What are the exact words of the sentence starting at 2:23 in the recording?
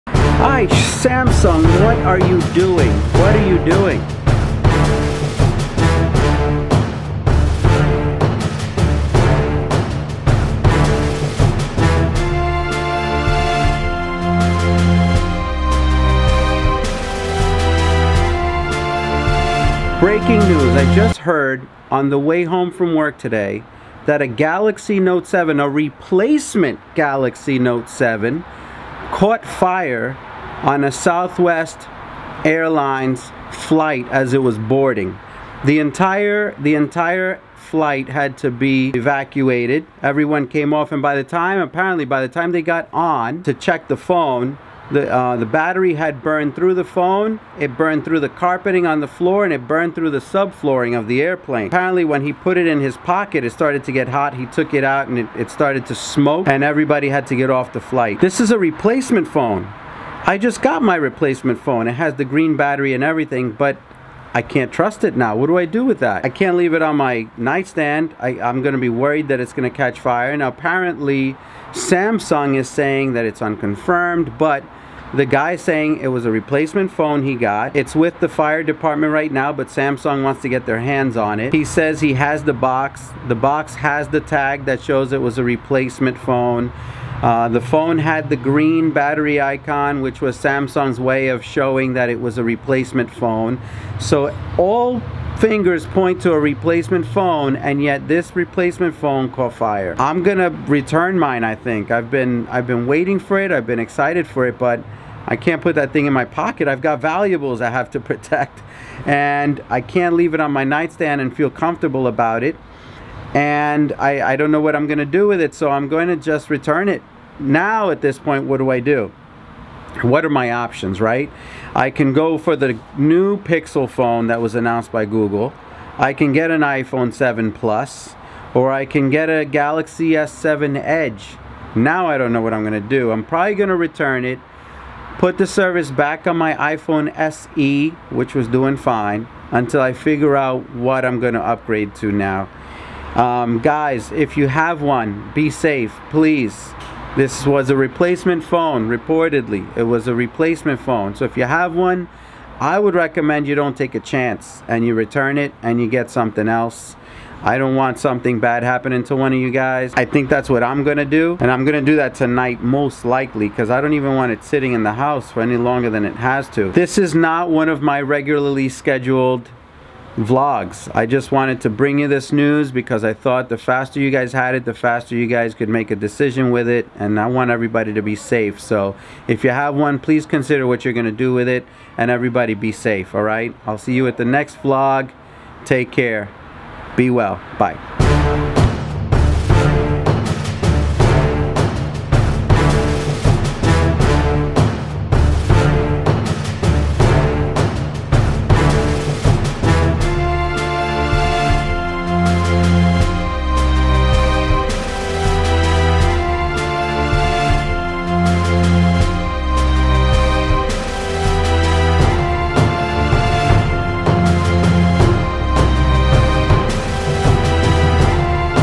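Um, guys, if you have one, be safe, please.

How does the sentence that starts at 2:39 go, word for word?
I think that's what I'm gonna do.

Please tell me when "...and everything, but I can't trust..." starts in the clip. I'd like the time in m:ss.
1:02.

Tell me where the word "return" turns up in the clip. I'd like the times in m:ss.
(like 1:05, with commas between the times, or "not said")
1:40, 1:56, 2:13, 2:34.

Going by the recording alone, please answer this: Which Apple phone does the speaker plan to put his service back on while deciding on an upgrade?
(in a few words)
iPhone SE.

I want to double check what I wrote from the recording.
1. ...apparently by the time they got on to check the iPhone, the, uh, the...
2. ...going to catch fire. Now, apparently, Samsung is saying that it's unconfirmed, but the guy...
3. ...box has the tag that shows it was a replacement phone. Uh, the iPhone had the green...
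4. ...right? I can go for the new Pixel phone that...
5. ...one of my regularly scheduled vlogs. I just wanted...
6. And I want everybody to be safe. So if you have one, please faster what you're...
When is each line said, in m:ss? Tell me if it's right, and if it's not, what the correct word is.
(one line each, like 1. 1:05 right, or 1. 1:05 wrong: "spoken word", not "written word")
1. 0:41 wrong: "phone", not "iPhone"
2. 1:09 right
3. 1:23 wrong: "phone", not "iPhone"
4. 2:01 right
5. 2:47 right
6. 2:56 wrong: "consider", not "faster".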